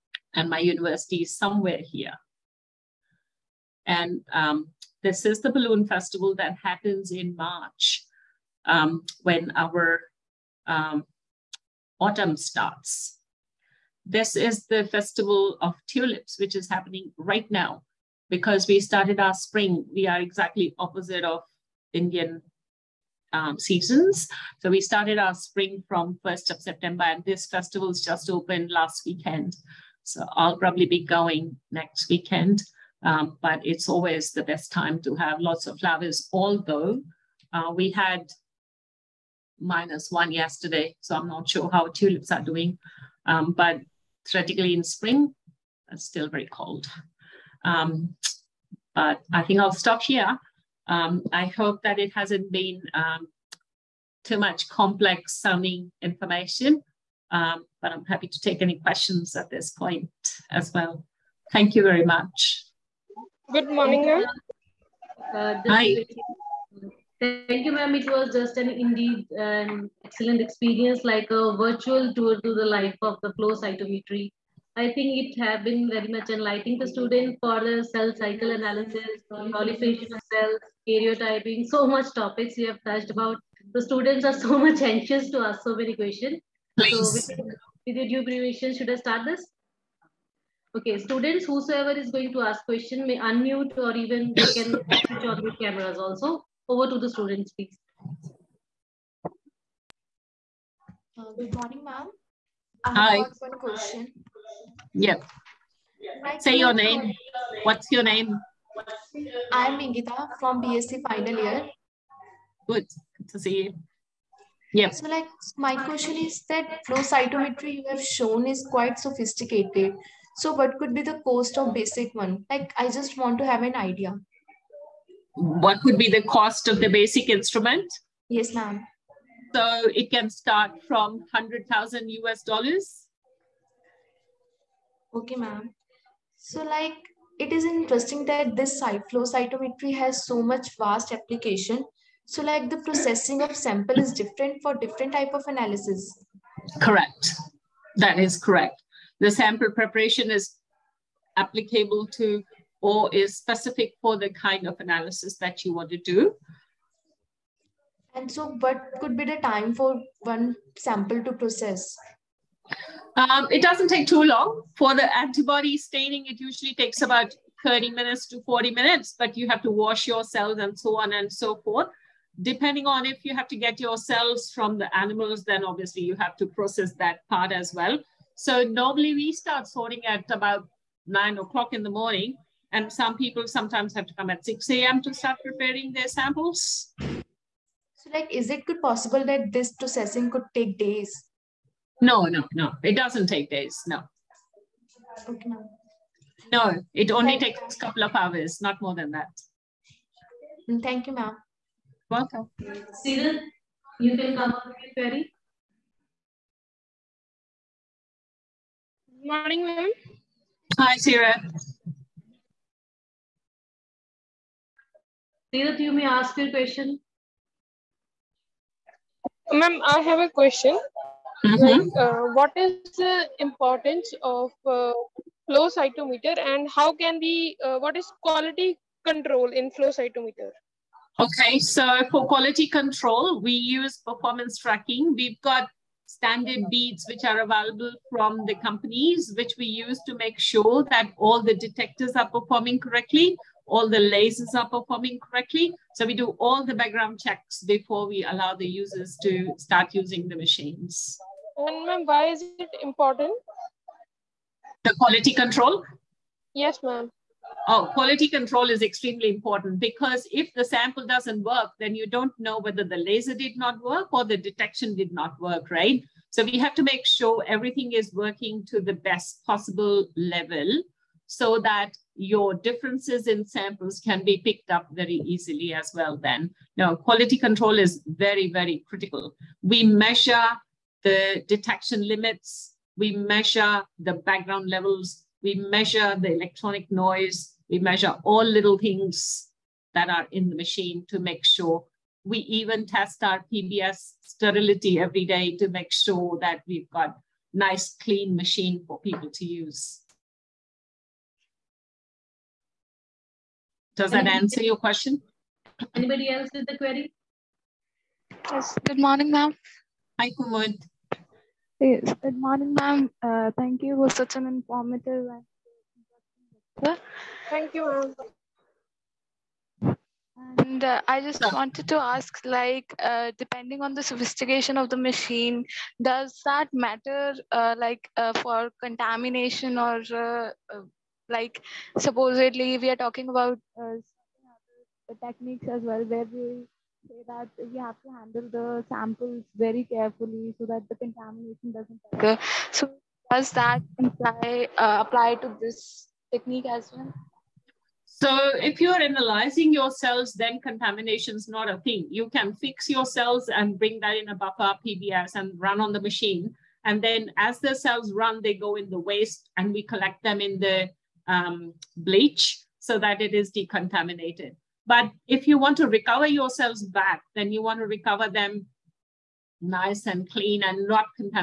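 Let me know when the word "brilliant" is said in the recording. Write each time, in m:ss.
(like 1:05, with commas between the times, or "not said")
not said.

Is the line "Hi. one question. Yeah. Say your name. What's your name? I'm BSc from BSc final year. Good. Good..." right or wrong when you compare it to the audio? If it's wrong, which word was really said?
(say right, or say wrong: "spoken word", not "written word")
wrong: "Ingita", not "BSc".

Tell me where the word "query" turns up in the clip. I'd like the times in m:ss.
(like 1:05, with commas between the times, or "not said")
3:24, 5:06.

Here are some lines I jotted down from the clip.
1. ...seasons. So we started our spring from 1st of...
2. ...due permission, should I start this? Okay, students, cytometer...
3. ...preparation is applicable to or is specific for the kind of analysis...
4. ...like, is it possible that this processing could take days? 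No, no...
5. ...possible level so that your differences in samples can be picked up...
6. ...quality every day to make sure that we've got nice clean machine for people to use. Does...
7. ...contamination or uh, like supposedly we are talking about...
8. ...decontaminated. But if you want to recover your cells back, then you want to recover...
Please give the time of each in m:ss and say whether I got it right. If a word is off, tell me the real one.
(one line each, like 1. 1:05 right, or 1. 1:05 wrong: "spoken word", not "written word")
1. 0:23 right
2. 1:28 wrong: "whosoever", not "cytometer"
3. 2:29 right
4. 3:08 right
5. 4:29 right
6. 4:54 wrong: "sterility", not "quality"
7. 5:28 right
8. 6:03 right.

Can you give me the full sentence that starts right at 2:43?
Um, it doesn't take too long.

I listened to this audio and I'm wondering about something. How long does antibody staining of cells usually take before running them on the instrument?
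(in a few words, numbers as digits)
30 to 40 minutes.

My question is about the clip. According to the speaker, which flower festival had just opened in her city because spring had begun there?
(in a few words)
Festival of tulips.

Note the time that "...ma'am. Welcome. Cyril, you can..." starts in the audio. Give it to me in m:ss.
3:21.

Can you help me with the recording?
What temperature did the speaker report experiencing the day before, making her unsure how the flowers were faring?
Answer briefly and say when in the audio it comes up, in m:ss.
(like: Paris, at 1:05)
-1, at 0:39.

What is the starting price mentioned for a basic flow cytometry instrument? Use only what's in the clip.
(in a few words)
100,000 US dollars.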